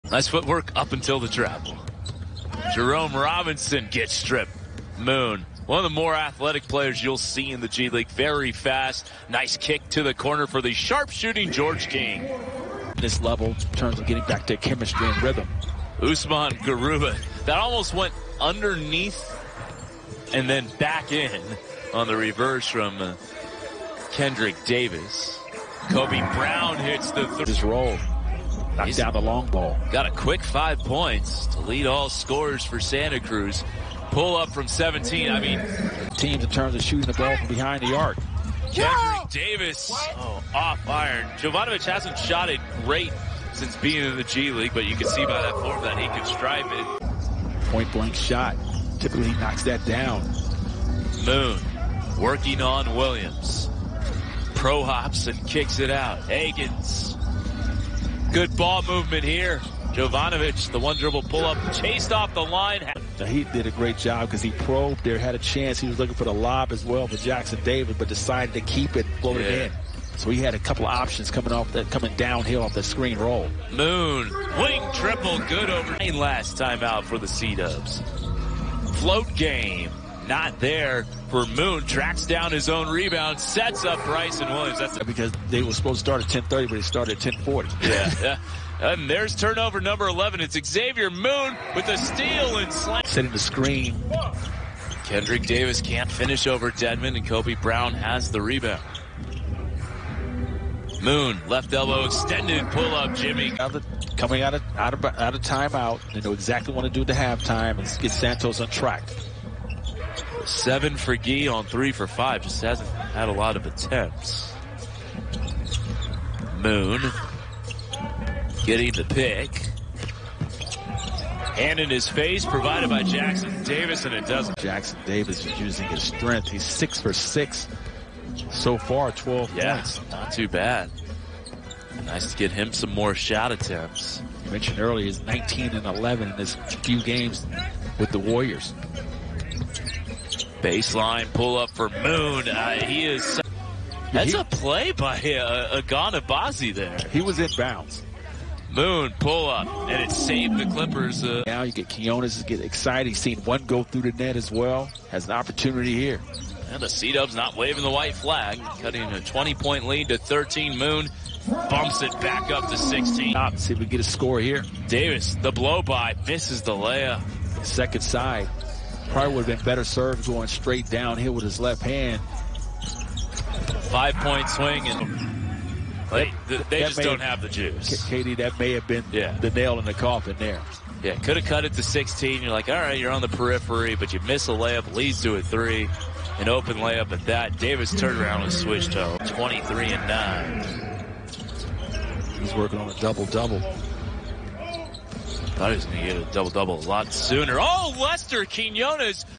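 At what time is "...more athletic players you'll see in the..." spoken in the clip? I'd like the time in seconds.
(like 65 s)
5 s.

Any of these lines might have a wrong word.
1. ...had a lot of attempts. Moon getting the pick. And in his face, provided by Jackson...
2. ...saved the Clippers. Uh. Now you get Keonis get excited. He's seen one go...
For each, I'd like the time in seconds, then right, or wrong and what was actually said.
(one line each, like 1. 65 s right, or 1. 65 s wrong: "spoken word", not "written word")
1. 112 s right
2. 150 s right.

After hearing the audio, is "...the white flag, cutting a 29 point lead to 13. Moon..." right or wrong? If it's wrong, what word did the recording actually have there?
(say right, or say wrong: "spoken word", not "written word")
wrong: "20", not "29".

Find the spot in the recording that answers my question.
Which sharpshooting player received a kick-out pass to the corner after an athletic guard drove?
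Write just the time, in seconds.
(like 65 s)
11 s.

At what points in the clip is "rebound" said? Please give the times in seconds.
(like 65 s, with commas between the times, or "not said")
82 s, 98 s.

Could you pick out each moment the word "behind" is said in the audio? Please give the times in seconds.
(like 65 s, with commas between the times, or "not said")
37 s.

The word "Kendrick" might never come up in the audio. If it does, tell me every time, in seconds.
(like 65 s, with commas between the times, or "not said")
24 s, 38 s, 95 s.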